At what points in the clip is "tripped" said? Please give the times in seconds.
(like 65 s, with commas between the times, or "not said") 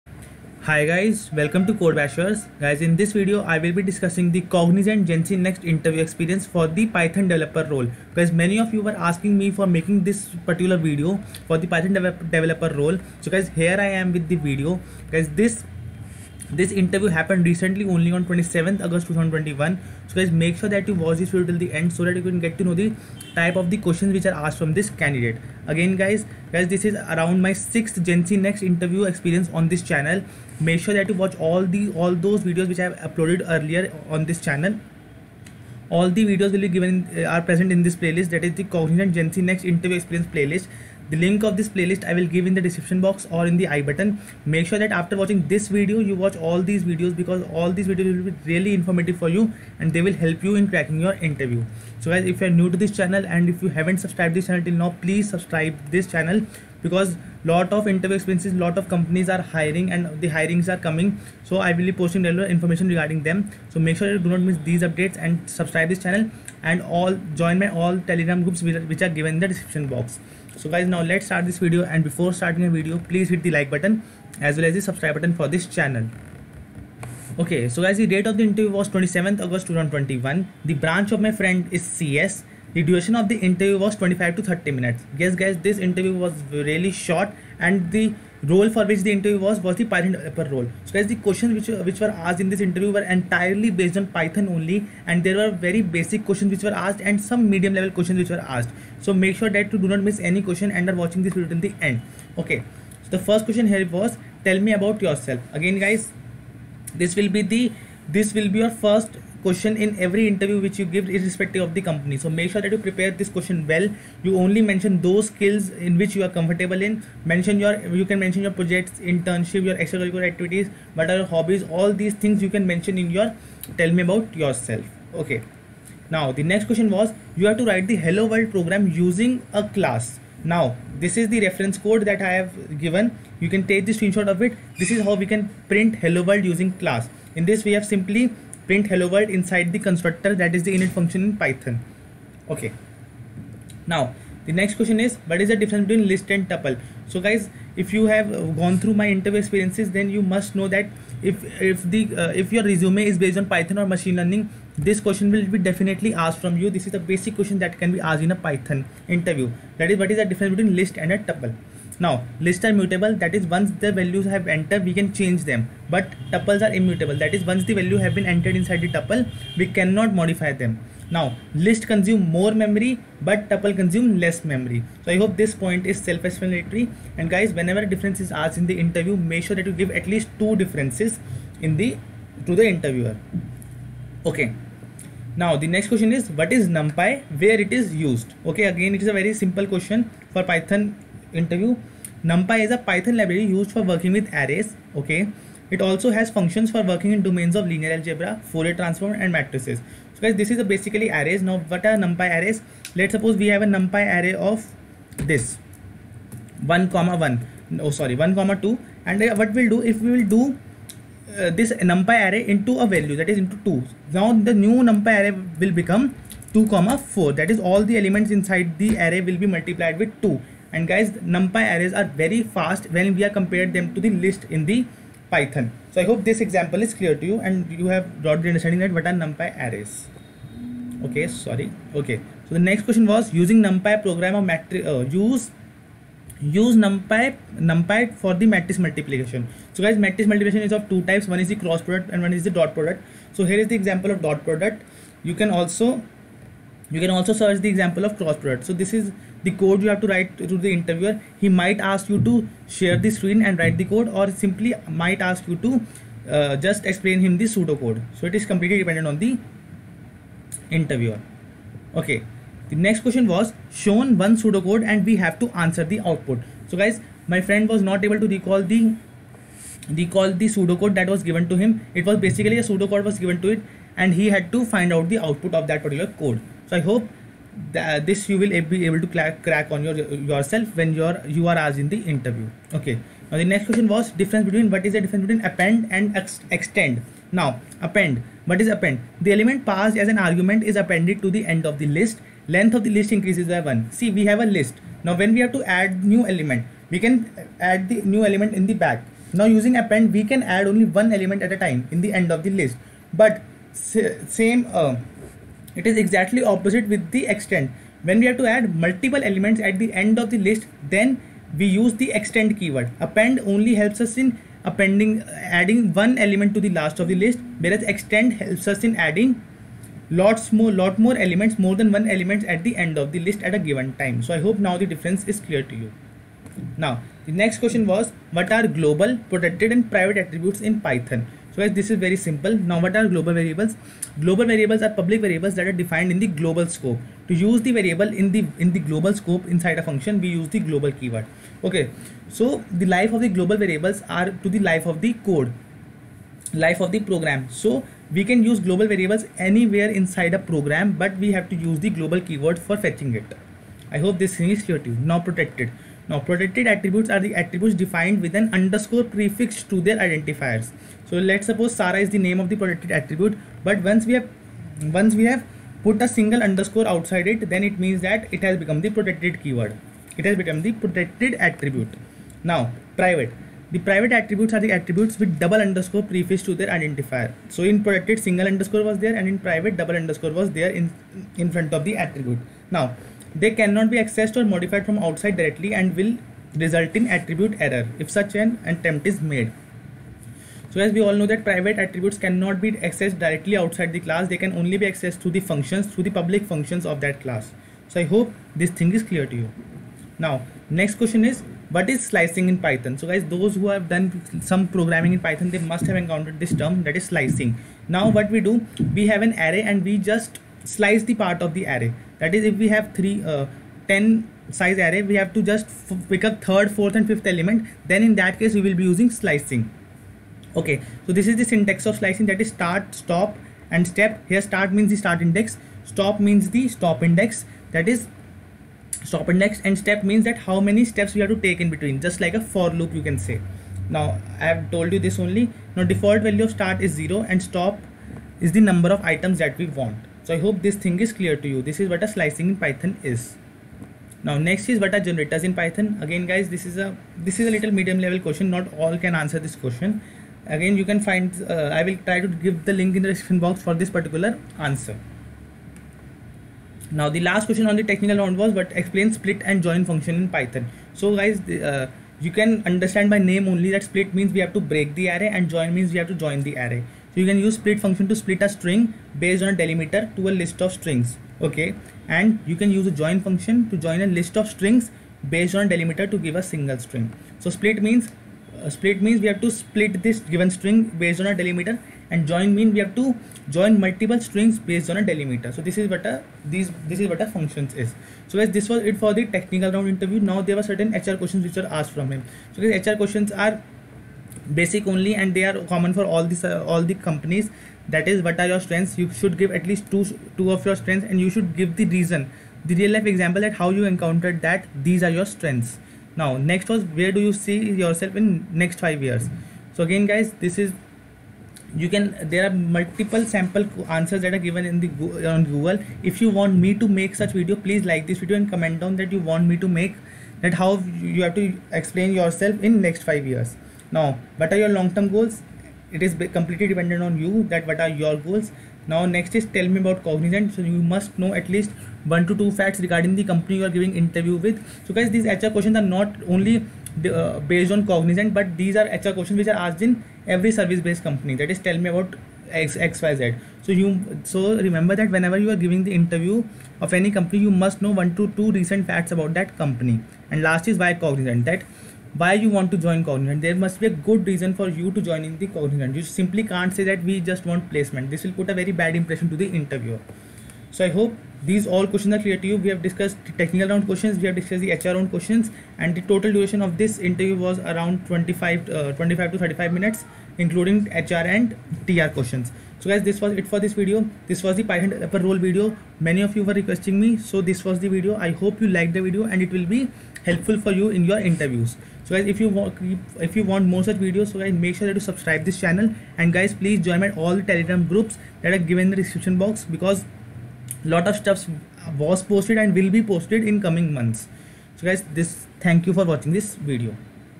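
not said.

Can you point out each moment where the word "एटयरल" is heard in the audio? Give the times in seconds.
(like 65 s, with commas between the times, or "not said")
93 s.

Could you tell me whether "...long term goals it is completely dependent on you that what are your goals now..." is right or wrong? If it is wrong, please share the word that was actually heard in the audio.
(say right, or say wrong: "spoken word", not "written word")
right.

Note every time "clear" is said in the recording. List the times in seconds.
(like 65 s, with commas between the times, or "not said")
226 s, 325 s, 354 s, 399 s, 441 s, 562 s.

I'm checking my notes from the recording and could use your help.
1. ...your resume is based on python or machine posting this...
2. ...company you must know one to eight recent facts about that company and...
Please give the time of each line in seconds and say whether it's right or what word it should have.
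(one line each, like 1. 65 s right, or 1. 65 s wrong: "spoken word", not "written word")
1. 152 s wrong: "learning", not "posting"
2. 547 s wrong: "two", not "eight".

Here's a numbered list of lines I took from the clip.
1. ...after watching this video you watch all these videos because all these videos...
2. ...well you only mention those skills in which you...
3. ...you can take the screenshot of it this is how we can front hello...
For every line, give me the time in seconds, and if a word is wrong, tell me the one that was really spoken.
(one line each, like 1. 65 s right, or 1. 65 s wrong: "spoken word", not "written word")
1. 44 s right
2. 113 s right
3. 133 s wrong: "print", not "front".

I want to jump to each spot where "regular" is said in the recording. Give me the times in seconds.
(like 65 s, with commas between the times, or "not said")
62 s.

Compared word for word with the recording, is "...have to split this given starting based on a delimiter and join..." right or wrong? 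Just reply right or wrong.
wrong.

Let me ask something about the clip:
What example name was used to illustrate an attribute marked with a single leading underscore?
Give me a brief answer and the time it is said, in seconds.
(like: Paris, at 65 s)
Sara, at 361 s.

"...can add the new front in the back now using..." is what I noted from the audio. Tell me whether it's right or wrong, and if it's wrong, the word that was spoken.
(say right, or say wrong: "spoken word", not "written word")
wrong: "element", not "front".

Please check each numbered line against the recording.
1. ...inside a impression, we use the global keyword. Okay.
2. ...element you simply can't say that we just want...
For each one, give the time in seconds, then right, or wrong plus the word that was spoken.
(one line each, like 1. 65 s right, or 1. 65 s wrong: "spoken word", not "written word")
1. 339 s wrong: "function", not "impression"
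2. 555 s wrong: "cognizant", not "element".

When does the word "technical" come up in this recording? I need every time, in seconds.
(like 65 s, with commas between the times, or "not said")
457 s, 489 s, 563 s.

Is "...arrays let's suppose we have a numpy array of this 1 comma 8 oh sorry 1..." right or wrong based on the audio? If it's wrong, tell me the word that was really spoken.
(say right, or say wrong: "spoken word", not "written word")
wrong: "1", not "8".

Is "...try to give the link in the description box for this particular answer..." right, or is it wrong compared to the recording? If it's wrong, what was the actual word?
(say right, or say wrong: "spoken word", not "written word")
right.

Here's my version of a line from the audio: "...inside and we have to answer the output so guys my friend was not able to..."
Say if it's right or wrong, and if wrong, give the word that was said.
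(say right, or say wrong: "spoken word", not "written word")
wrong: "pseudocode", not "inside".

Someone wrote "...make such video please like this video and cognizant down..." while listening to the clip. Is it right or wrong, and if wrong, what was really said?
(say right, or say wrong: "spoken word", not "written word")
wrong: "comment", not "cognizant".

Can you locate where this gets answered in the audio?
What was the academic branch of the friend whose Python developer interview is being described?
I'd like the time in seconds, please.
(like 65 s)
81 s.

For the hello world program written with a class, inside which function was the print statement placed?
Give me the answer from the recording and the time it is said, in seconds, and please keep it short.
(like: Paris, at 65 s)
init function, at 140 s.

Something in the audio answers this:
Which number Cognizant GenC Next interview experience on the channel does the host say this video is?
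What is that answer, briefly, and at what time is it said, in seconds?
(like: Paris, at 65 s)
sixth, at 27 s.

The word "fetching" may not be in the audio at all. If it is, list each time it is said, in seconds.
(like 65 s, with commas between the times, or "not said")
352 s.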